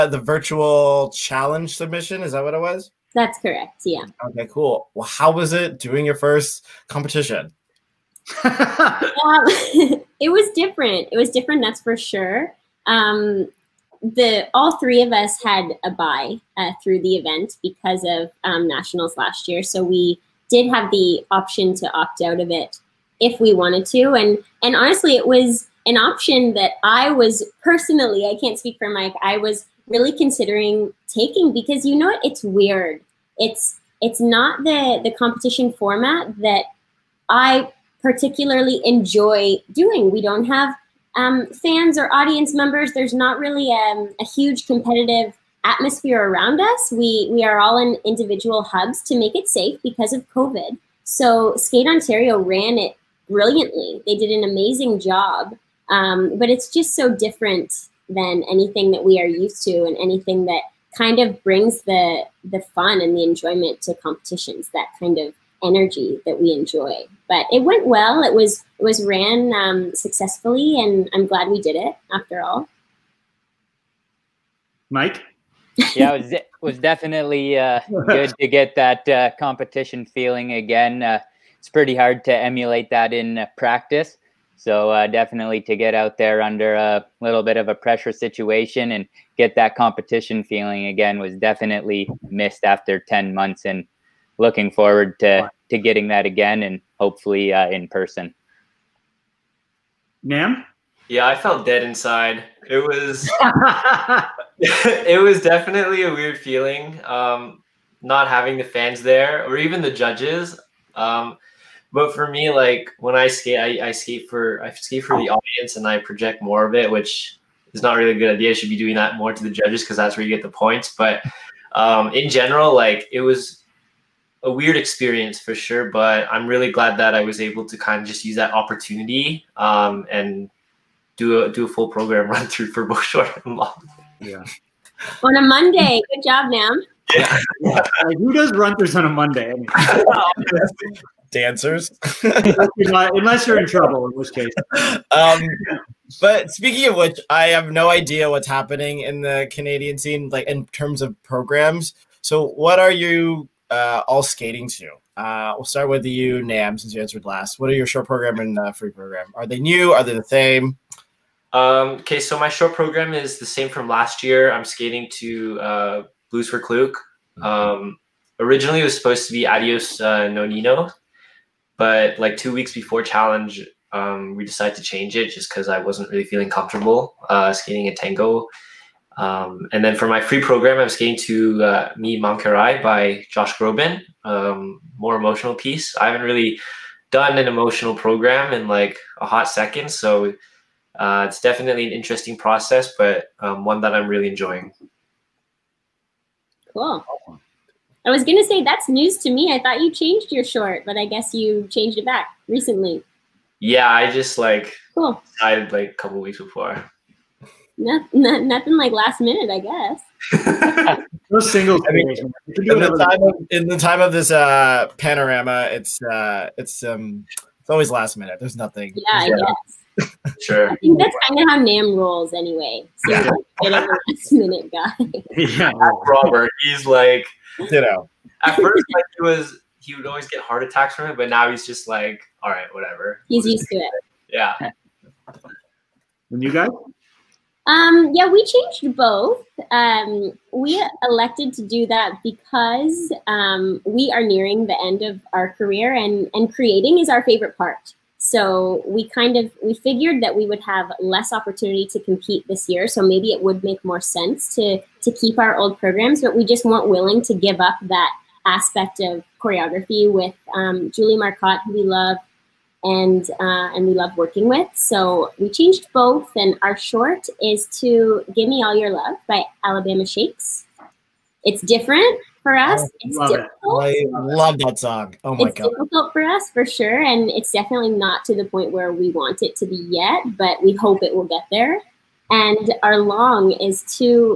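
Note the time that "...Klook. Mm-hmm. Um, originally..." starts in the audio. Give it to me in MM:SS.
02:46.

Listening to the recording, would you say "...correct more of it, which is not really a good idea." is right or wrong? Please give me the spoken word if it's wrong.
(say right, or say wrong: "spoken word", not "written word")
wrong: "project", not "correct".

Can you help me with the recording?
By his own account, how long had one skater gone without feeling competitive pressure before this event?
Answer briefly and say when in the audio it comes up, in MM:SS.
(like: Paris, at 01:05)
10 months, at 01:33.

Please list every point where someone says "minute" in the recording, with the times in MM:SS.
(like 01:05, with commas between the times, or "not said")
03:29, 03:38, 03:44.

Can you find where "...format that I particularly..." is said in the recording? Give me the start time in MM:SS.
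00:35.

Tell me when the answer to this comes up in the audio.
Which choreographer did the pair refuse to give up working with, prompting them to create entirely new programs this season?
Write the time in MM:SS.
04:20.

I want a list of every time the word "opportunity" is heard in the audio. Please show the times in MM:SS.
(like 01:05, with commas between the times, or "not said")
02:08, 04:11.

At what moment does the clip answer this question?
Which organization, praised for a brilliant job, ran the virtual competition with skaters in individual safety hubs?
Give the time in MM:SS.
00:51.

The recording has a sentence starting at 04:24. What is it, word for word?
So we changed both, and our short is to "Give Me All Your Love" by Alabama Shakes.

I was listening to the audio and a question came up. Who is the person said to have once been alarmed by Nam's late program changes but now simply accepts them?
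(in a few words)
Robert.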